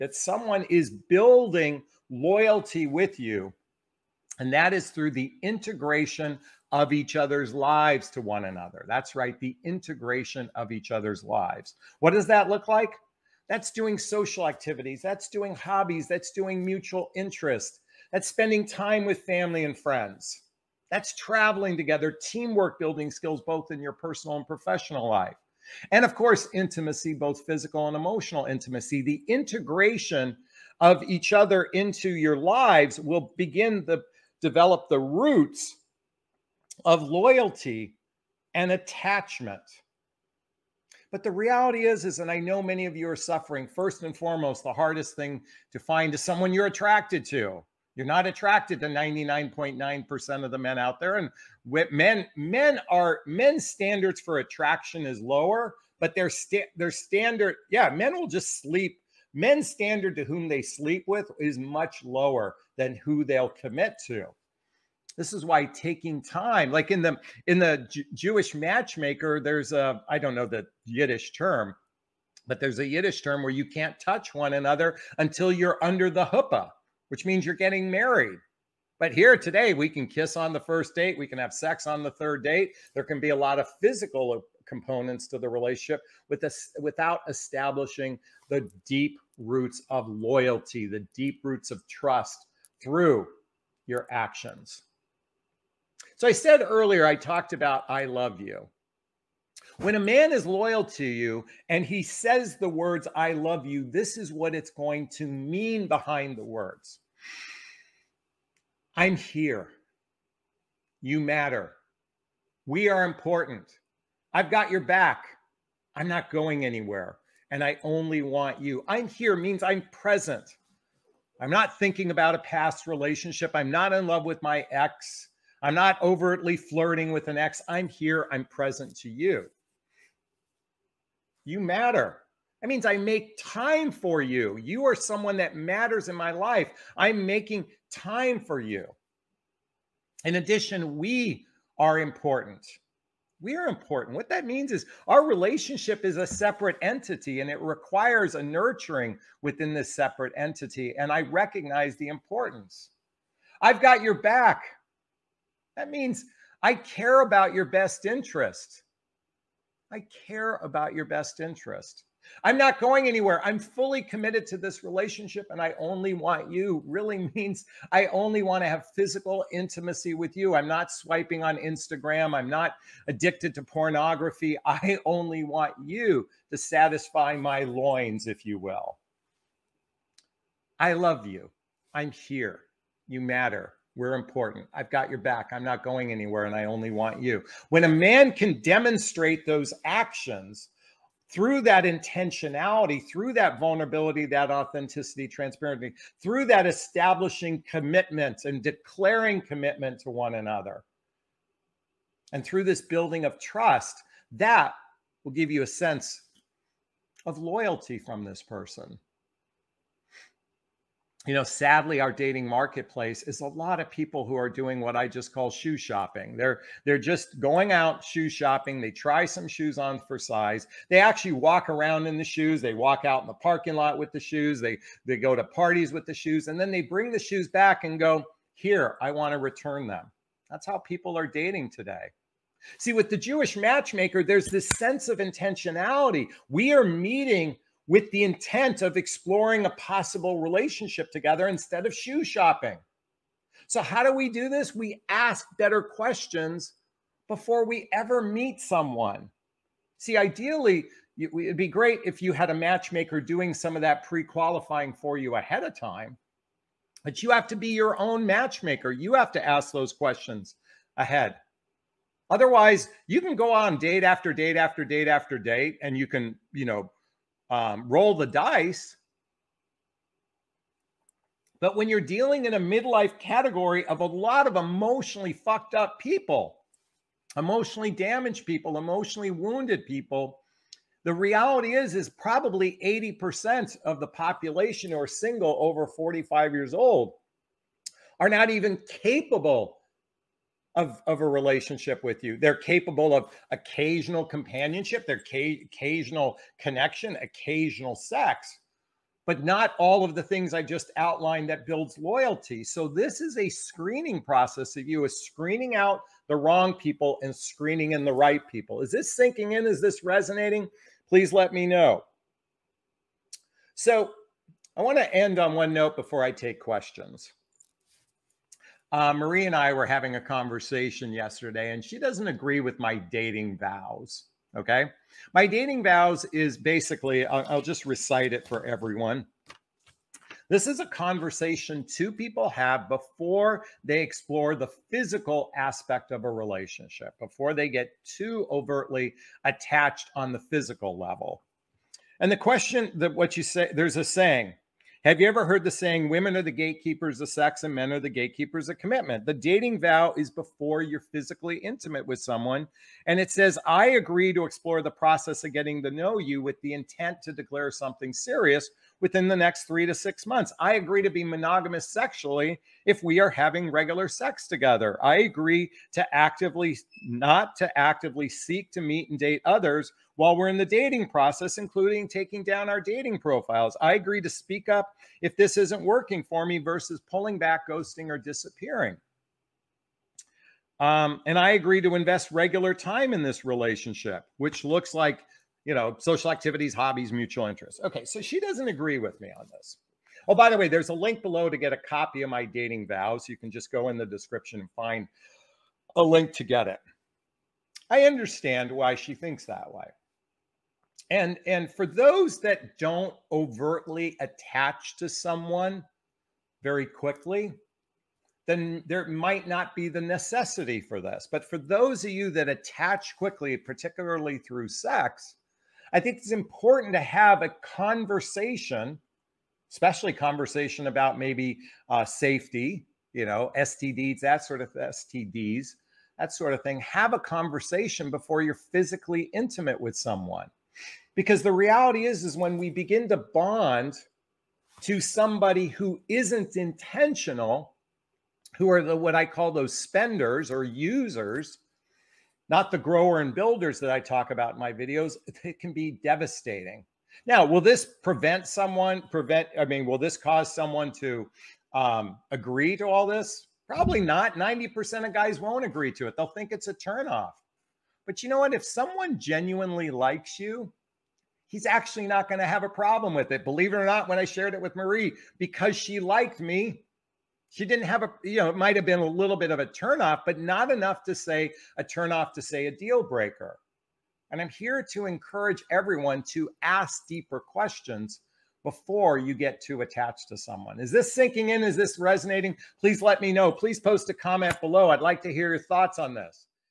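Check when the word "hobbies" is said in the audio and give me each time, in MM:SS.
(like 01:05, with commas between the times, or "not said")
00:15, 06:26.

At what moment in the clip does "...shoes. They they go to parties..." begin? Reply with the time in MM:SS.
03:44.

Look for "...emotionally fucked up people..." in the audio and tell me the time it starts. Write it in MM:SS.
04:34.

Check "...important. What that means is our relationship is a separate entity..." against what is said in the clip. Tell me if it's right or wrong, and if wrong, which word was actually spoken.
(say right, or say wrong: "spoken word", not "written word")
right.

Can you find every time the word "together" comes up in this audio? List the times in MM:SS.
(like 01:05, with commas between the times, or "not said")
00:21, 04:01, 06:04.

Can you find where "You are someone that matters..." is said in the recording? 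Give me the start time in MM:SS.
02:14.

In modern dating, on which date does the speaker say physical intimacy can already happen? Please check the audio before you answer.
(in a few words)
third date.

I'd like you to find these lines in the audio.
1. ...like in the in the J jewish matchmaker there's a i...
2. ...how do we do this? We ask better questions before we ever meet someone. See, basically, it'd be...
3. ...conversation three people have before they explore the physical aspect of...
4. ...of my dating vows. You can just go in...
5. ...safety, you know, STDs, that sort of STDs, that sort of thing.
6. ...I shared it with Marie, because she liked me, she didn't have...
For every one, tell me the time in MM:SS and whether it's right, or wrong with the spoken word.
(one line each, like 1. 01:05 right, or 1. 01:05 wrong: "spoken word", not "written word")
1. 01:06 right
2. 04:03 wrong: "ideally", not "basically"
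3. 05:30 wrong: "two", not "three"
4. 06:32 right
5. 07:02 right
6. 07:44 right.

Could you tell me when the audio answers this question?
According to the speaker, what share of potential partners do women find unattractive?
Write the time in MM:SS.
00:48.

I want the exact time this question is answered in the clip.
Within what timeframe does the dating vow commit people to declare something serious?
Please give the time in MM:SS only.
05:59.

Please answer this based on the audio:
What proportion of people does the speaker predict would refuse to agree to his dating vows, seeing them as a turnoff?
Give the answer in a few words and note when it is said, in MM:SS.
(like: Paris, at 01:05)
90%, at 07:34.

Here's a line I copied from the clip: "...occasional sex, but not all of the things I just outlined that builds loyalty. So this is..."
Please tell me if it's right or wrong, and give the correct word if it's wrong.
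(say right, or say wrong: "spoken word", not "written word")
right.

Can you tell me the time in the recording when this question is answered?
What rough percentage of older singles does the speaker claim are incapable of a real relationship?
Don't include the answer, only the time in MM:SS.
04:42.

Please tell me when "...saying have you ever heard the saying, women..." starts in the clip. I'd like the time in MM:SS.
05:44.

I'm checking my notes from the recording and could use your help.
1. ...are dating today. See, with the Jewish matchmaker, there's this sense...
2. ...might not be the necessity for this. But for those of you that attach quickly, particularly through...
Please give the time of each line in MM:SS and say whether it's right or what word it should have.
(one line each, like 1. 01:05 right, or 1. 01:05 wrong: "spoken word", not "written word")
1. 03:51 right
2. 06:49 right.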